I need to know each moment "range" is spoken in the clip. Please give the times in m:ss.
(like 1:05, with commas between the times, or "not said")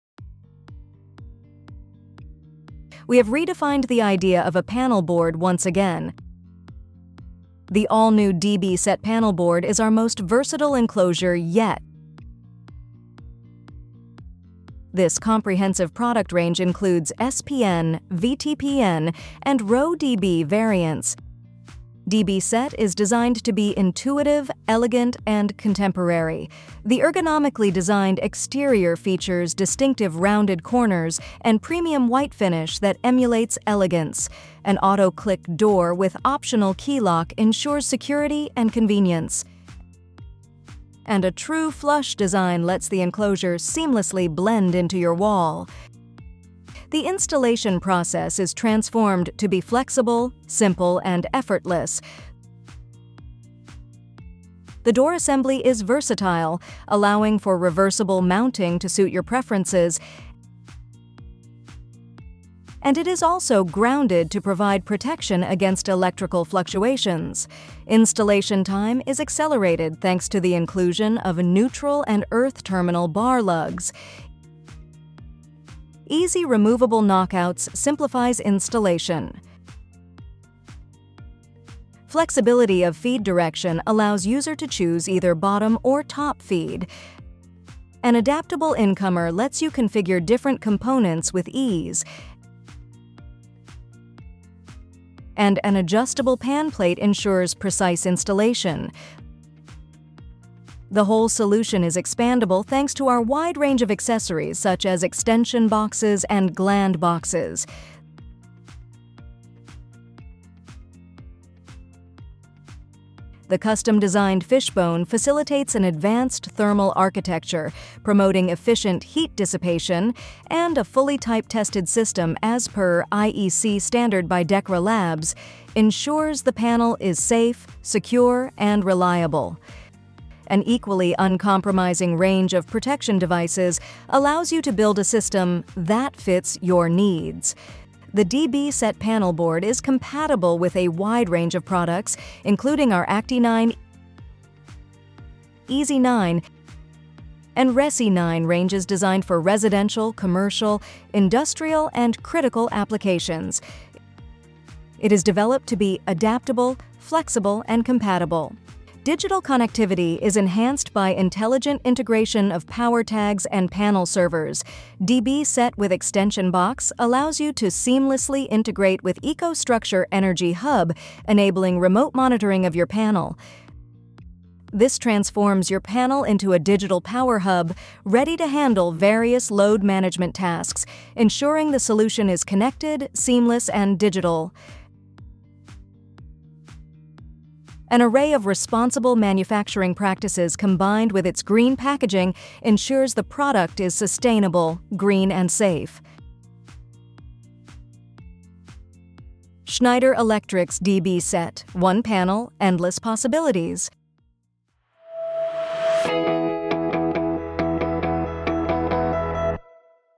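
0:16, 1:43, 2:12, 2:21, 2:28.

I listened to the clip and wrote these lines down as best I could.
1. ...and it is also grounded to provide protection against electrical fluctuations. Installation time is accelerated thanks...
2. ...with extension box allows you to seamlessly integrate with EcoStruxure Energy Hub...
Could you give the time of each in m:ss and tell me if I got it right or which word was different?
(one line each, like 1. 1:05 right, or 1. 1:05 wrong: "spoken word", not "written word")
1. 1:02 right
2. 2:45 right.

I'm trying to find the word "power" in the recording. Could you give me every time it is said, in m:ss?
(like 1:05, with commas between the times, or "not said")
2:42, 2:57.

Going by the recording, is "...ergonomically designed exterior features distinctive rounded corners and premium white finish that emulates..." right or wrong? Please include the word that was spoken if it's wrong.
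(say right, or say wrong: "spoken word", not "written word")
right.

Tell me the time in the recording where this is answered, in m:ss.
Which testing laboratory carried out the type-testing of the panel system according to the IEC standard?
2:04.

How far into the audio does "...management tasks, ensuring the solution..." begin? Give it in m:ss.
2:59.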